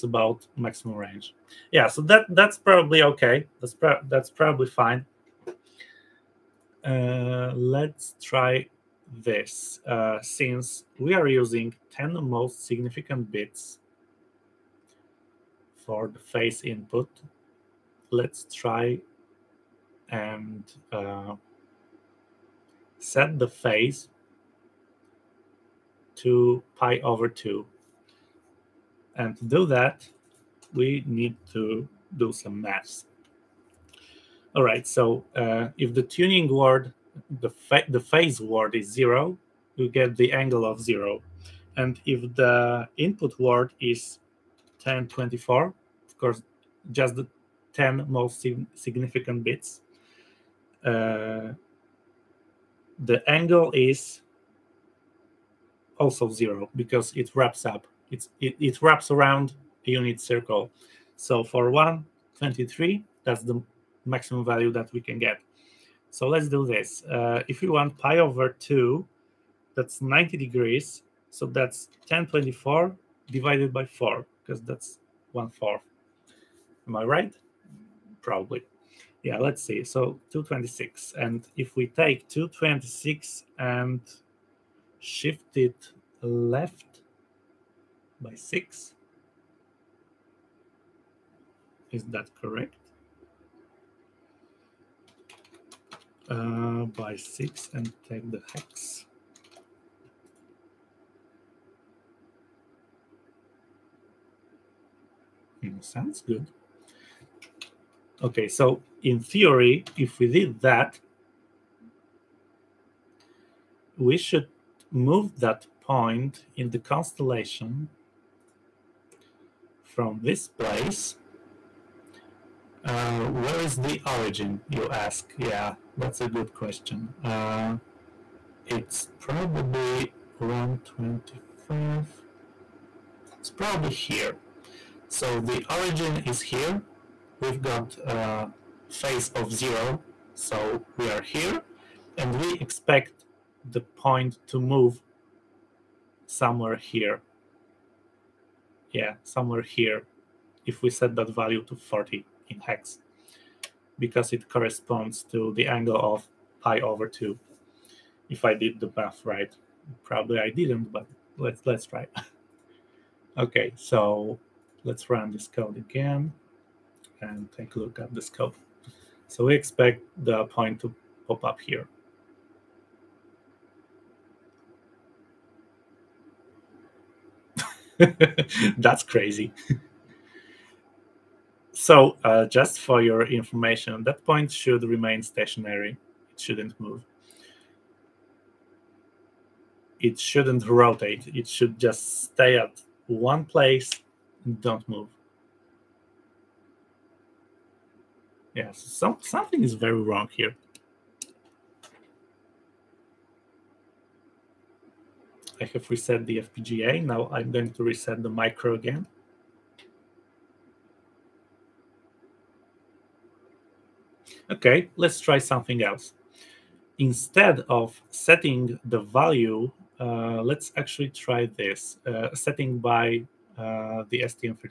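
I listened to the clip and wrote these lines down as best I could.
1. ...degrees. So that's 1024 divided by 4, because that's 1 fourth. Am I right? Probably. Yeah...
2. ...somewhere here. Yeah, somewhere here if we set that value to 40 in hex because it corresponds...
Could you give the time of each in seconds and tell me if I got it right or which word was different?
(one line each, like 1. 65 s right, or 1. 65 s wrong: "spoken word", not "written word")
1. 70 s right
2. 146 s right.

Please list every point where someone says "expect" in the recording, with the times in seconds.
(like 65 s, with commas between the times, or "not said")
142 s, 169 s.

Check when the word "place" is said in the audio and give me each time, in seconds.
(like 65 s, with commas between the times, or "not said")
120 s, 193 s.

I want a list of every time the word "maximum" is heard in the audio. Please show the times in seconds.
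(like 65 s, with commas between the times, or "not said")
0 s, 64 s.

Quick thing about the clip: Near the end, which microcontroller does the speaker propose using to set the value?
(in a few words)
STM32.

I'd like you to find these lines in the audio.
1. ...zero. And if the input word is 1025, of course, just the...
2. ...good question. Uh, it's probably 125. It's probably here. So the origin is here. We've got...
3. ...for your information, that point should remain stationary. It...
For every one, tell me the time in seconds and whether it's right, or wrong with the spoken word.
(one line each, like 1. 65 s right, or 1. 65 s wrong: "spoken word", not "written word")
1. 40 s wrong: "1024", not "1025"
2. 126 s right
3. 182 s right.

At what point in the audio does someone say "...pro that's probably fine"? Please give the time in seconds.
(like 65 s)
3 s.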